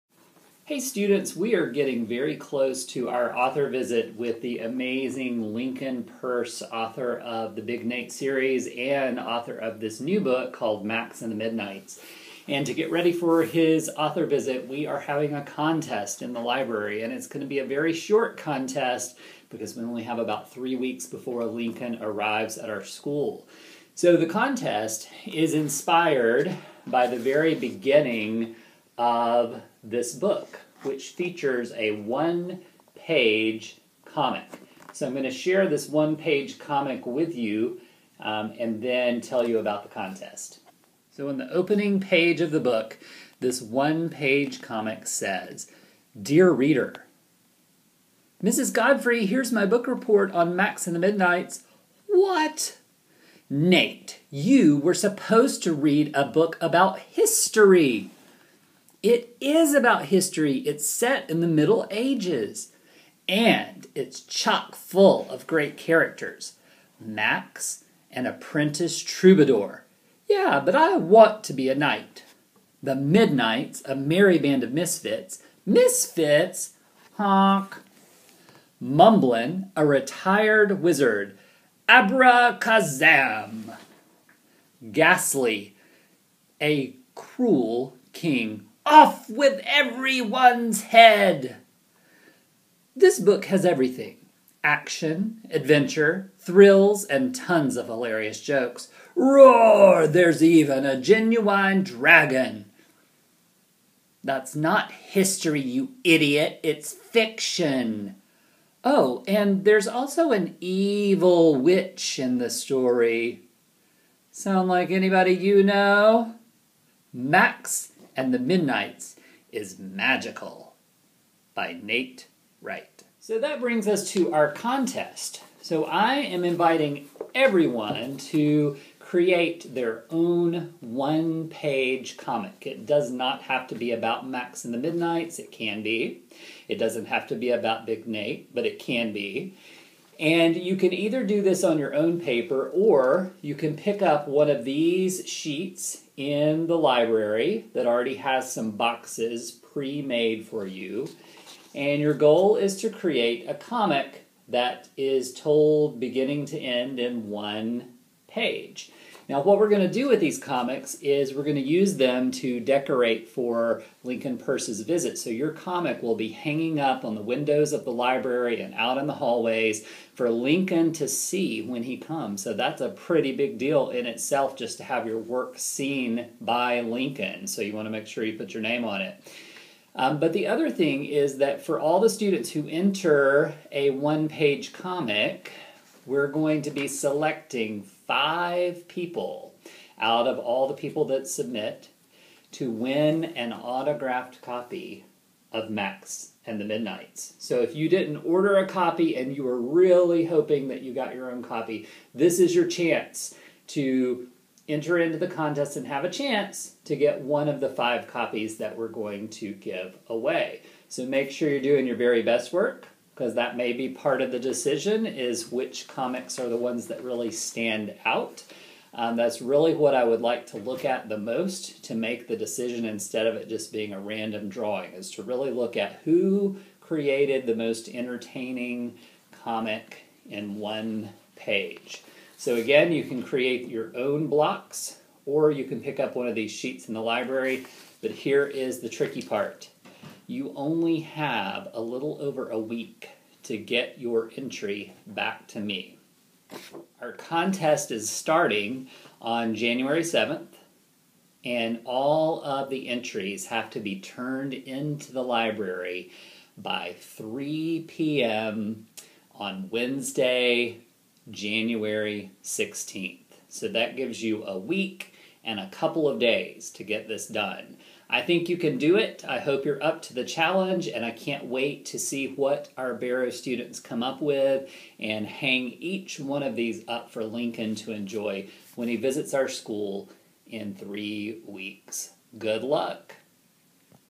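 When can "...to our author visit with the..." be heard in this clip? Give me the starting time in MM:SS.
00:02.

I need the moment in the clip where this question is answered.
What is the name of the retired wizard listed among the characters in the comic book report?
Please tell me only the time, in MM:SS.
01:18.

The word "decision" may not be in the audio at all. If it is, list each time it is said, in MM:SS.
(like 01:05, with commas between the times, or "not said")
03:34, 03:42.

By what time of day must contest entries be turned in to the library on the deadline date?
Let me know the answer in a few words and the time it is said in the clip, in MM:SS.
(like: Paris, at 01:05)
3 p.m., at 04:16.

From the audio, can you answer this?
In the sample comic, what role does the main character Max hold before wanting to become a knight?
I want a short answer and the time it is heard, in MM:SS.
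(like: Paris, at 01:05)
Apprentice troubadour, at 01:08.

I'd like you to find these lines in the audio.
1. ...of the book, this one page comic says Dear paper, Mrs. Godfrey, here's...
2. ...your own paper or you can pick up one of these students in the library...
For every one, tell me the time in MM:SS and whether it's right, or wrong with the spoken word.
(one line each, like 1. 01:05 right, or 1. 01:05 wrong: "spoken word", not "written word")
1. 00:42 wrong: "reader", not "paper"
2. 02:21 wrong: "sheets", not "students".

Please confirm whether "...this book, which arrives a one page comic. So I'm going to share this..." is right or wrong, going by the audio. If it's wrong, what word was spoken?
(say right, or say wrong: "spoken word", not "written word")
wrong: "features", not "arrives".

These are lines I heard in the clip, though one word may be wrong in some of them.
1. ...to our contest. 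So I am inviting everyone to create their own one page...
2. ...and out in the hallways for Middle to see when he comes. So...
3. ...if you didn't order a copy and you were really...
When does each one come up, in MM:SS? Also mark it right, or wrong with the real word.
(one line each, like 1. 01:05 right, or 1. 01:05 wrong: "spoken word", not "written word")
1. 02:04 right
2. 02:48 wrong: "Lincoln", not "Middle"
3. 03:17 right.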